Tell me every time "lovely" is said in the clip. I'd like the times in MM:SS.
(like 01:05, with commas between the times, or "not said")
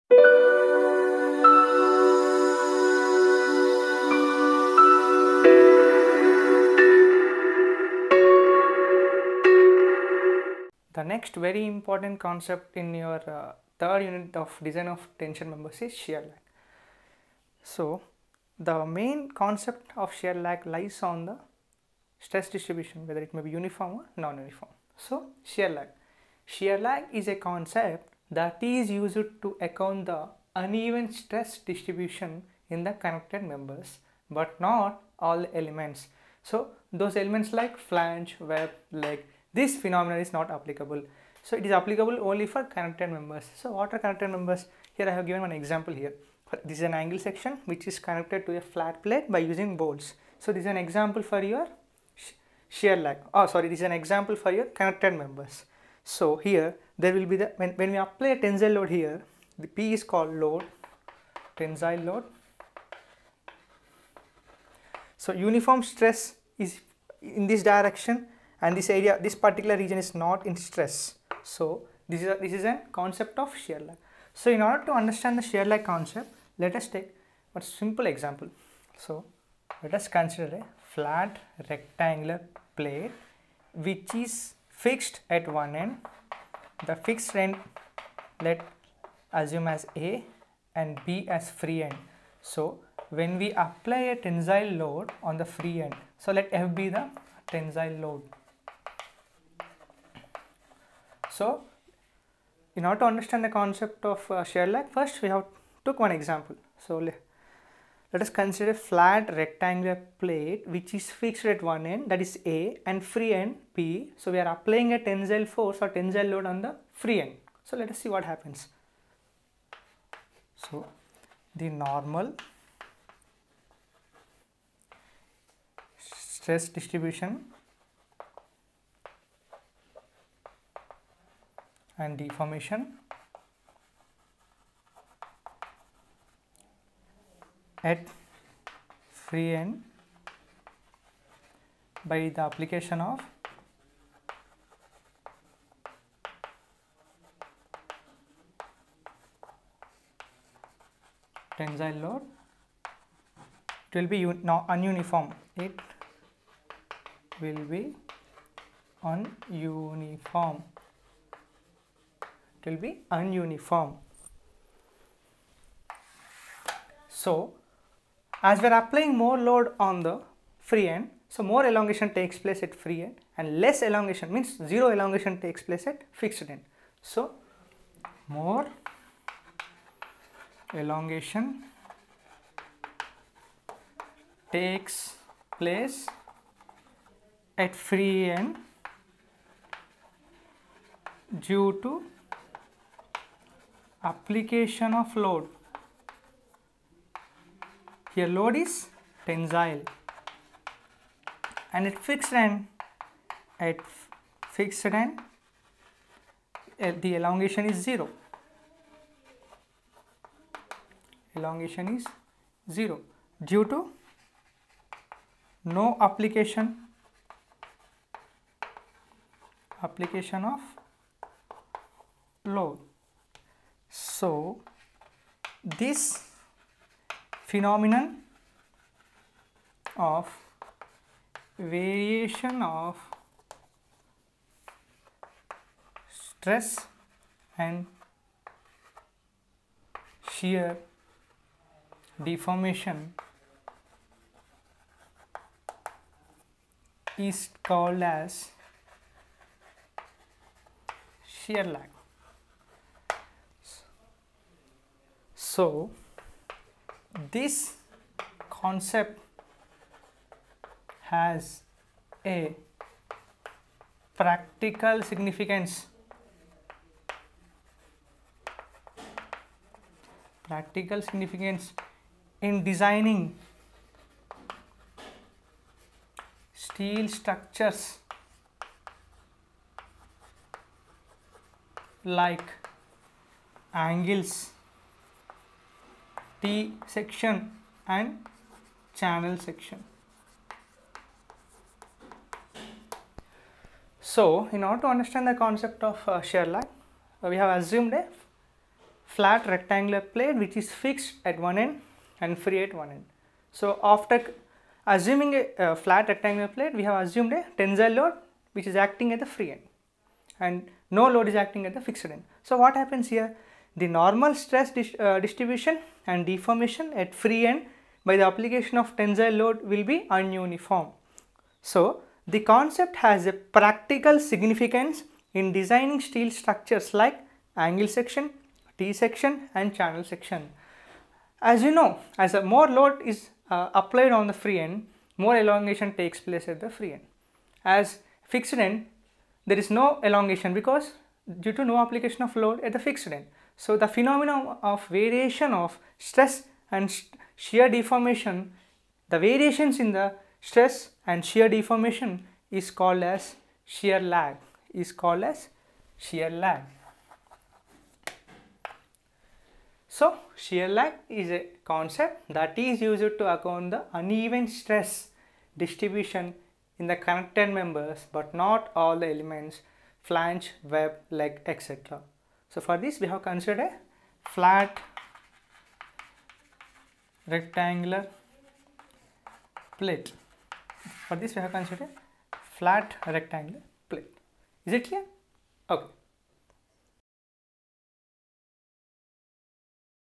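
not said.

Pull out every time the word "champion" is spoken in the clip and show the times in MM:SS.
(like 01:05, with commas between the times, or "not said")
not said.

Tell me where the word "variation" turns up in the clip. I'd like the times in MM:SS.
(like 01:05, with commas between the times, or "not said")
03:51, 05:44, 05:49.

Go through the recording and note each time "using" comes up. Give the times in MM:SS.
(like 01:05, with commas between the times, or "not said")
00:49.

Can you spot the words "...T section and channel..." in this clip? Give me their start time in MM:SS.
04:46.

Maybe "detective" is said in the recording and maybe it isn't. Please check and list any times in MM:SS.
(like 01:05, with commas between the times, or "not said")
not said.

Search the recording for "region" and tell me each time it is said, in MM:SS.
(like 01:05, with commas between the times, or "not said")
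01:09.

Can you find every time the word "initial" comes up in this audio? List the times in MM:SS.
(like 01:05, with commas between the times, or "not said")
not said.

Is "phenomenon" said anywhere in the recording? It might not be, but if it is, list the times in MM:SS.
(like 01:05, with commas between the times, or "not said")
00:39, 03:47, 05:43.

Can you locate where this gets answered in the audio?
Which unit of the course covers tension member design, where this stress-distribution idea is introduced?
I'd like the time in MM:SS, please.
00:13.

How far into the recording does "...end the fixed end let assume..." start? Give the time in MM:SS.
01:25.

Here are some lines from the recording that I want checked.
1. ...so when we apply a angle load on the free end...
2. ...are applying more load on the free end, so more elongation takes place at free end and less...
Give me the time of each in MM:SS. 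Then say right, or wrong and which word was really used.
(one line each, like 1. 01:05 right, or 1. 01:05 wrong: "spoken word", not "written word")
1. 01:32 wrong: "tensile", not "angle"
2. 02:48 right.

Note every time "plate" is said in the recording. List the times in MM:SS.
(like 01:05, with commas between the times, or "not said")
00:49, 01:22, 01:50, 05:00, 05:06, 06:19, 06:23.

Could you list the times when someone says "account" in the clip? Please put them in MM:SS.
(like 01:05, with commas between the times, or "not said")
00:29, 06:03.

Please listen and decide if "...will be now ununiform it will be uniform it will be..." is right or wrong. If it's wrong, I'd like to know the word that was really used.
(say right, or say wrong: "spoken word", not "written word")
wrong: "ununiform", not "uniform".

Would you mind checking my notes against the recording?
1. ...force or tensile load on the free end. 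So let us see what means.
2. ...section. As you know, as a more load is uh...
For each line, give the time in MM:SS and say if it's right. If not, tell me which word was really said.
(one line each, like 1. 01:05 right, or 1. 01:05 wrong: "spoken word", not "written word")
1. 01:55 wrong: "happens", not "means"
2. 05:30 right.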